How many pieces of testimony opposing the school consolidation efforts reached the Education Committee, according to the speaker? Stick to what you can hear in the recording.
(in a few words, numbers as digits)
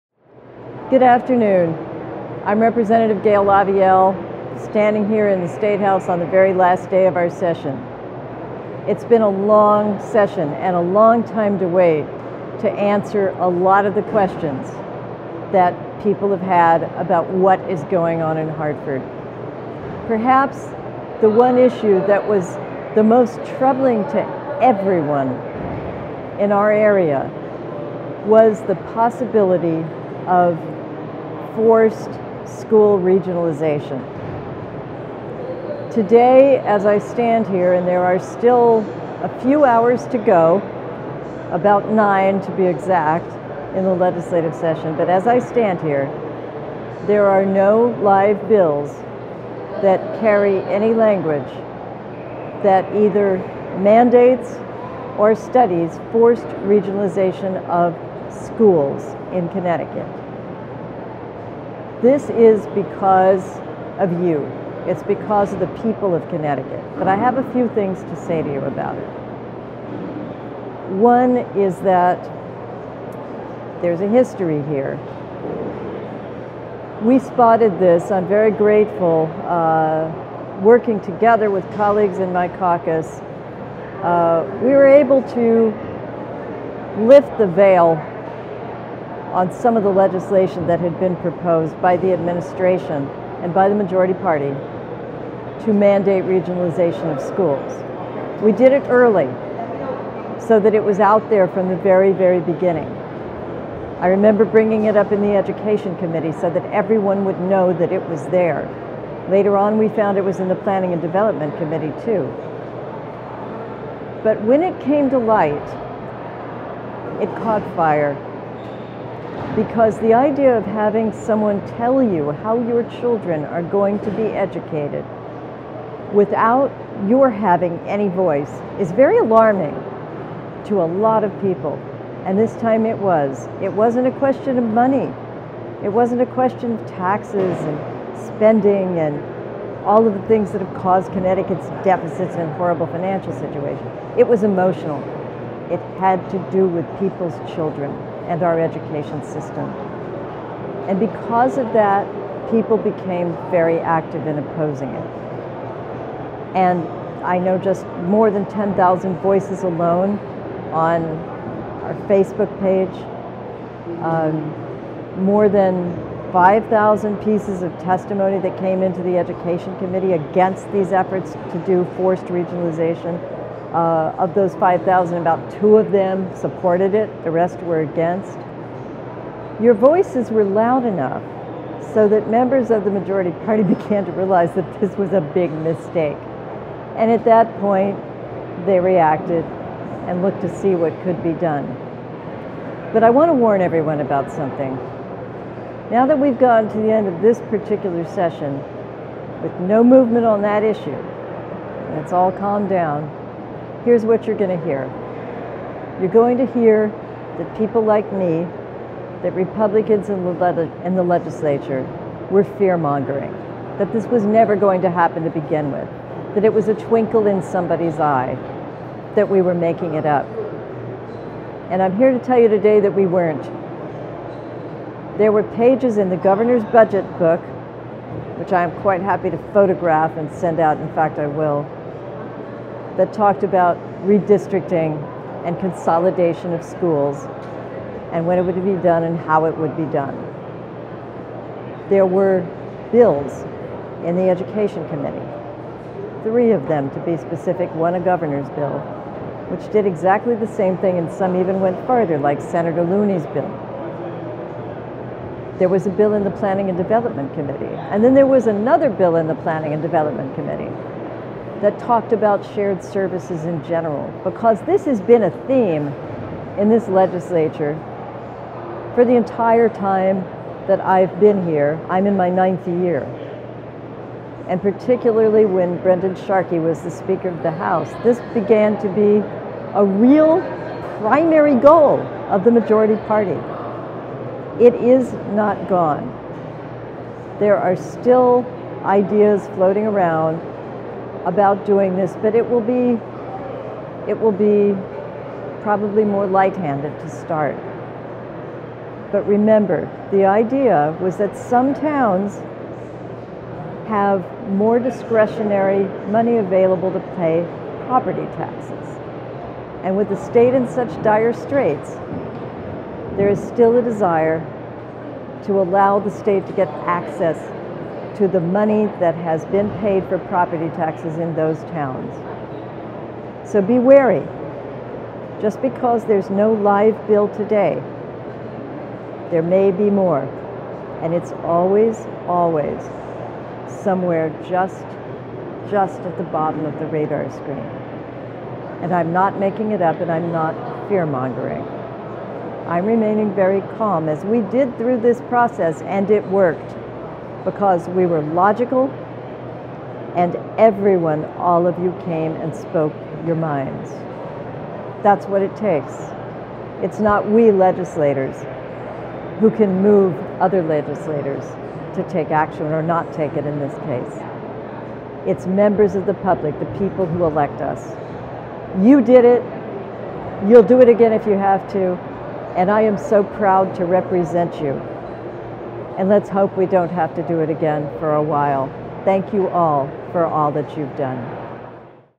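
More than 5,000.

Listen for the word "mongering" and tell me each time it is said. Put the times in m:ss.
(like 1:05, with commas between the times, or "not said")
3:32, 5:41.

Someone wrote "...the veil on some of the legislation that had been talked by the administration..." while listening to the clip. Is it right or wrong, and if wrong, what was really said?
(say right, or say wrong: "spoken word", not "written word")
wrong: "proposed", not "talked".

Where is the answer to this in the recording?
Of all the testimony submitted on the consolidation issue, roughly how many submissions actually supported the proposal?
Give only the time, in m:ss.
2:55.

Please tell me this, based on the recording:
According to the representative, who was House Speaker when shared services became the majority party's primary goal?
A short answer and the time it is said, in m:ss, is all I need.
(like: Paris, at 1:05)
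Brendan Sharkey, at 4:35.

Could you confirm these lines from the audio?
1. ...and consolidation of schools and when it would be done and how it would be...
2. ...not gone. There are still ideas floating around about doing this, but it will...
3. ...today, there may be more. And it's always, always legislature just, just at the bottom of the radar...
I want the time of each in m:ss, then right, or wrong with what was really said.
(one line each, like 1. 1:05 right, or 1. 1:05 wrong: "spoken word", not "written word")
1. 3:55 right
2. 4:45 right
3. 5:27 wrong: "somewhere", not "legislature".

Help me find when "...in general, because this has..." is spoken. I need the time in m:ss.
4:23.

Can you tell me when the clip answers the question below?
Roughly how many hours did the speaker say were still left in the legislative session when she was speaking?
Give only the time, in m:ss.
0:41.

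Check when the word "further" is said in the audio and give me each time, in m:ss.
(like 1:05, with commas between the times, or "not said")
4:11.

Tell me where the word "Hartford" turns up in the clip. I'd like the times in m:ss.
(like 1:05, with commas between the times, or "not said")
0:18.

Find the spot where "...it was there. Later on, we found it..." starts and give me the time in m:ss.
1:47.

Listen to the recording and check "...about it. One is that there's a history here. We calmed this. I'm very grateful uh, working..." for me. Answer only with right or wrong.
wrong.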